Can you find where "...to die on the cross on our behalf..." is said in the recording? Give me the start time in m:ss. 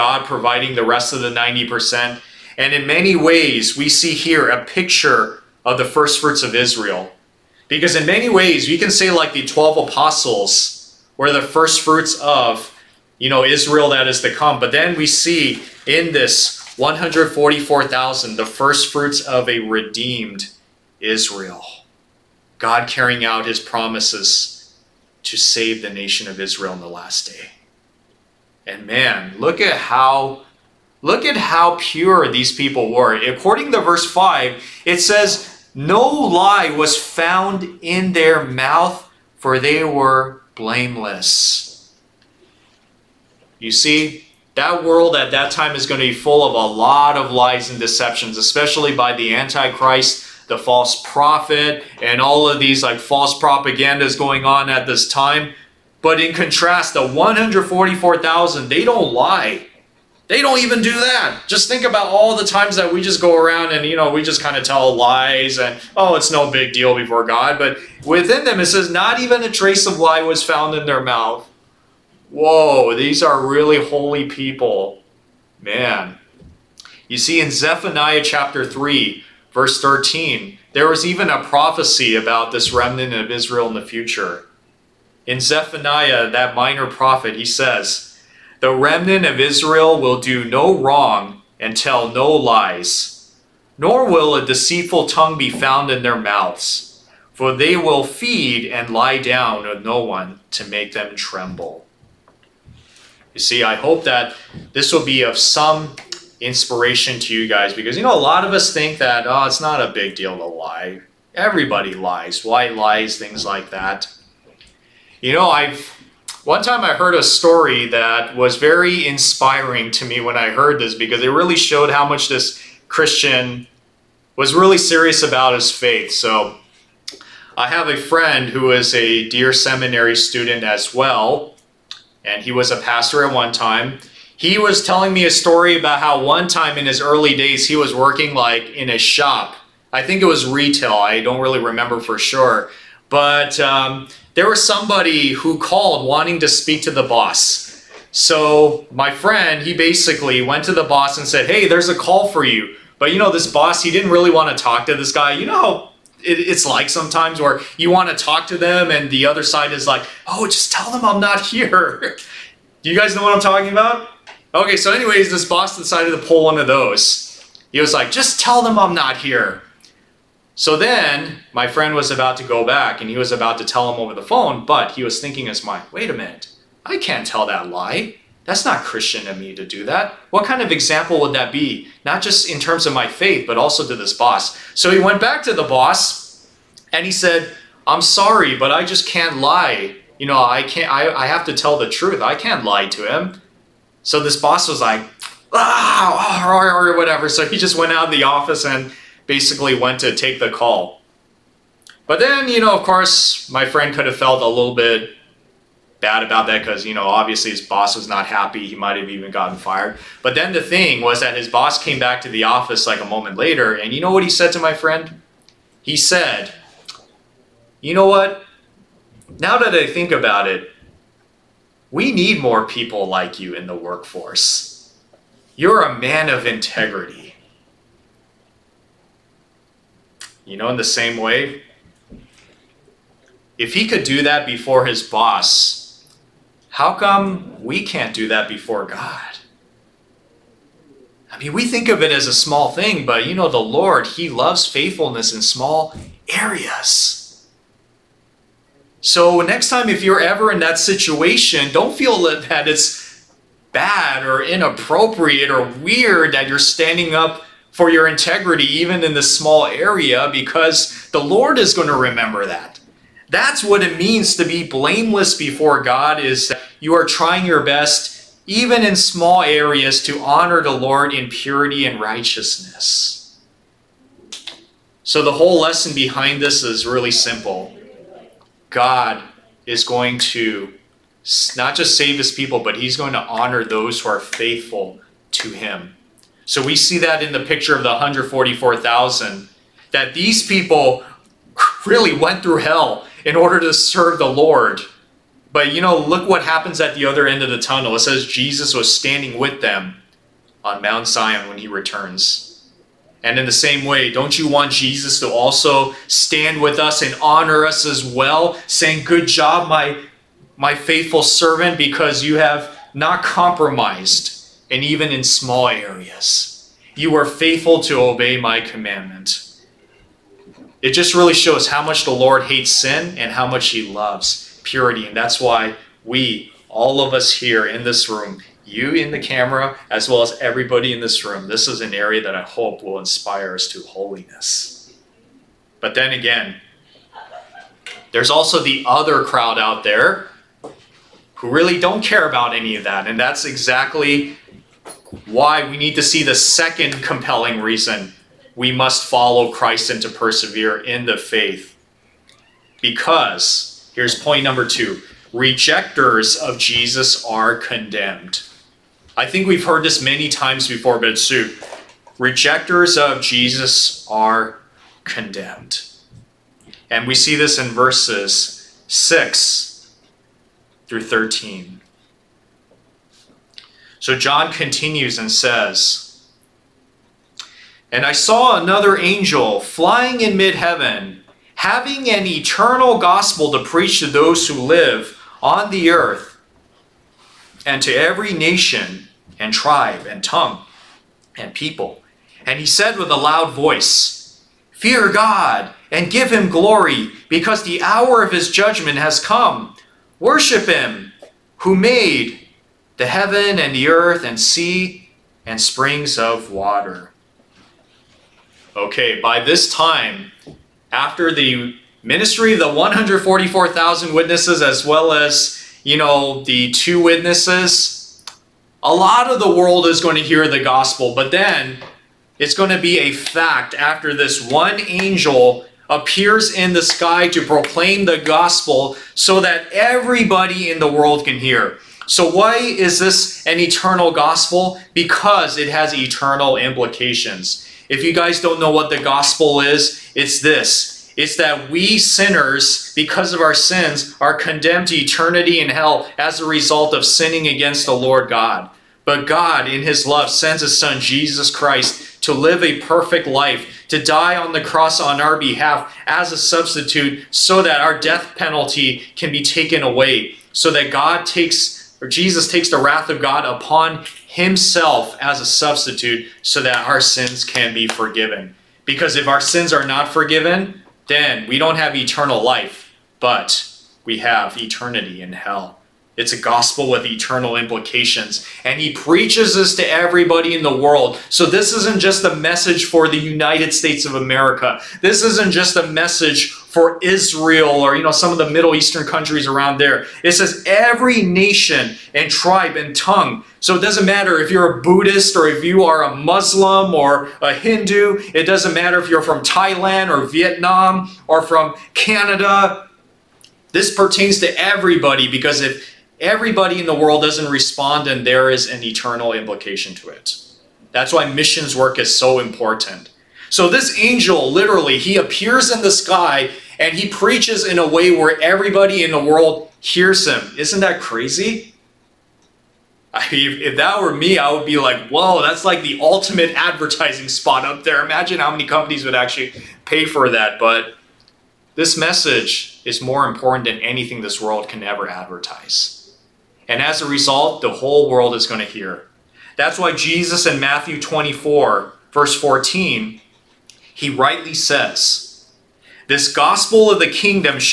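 7:33.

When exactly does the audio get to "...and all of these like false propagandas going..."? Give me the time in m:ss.
0:52.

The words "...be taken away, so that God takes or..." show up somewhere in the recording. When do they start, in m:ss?
7:39.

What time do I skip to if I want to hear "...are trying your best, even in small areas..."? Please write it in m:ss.
4:26.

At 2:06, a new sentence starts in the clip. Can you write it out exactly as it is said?
So I have a friend who is a dear seminary student as well, and he was a pastor at one time.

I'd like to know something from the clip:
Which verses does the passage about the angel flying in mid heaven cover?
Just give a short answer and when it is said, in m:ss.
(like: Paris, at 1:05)
6 through 13, at 6:07.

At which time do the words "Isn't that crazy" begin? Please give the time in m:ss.
8:40.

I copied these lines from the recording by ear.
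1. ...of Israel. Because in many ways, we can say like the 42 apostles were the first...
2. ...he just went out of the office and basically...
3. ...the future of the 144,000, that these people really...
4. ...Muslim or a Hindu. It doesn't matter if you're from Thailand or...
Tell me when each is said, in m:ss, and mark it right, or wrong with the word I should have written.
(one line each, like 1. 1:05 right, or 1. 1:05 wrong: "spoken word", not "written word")
1. 0:06 wrong: "12", not "42"
2. 3:17 right
3. 4:47 wrong: "picture", not "future"
4. 8:16 right.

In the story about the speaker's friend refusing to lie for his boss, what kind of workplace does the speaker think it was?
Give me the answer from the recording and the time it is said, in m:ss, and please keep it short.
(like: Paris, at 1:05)
Retail, at 2:20.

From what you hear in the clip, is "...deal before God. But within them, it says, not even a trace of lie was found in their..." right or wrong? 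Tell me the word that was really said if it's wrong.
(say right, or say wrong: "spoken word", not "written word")
right.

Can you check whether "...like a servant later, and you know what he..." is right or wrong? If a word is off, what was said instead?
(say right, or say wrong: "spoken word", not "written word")
wrong: "moment", not "servant".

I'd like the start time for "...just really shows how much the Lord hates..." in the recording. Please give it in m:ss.
5:20.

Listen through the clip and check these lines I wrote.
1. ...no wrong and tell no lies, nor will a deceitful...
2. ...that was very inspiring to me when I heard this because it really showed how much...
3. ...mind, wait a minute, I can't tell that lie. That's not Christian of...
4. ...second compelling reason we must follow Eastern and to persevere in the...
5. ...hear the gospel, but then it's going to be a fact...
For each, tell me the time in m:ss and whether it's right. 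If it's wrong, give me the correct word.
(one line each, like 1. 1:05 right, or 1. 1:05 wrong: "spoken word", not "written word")
1. 1:30 right
2. 1:57 right
3. 2:55 right
4. 5:46 wrong: "Christ", not "Eastern"
5. 7:00 right.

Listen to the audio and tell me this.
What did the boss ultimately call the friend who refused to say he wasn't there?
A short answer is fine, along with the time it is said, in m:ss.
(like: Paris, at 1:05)
A man of integrity, at 3:45.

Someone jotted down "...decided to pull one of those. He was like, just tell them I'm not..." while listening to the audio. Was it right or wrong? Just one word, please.
right.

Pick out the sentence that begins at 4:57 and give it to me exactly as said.
It says Jesus was standing with them on Mount Zion when he returns.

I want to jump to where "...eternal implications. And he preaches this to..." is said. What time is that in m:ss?
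7:57.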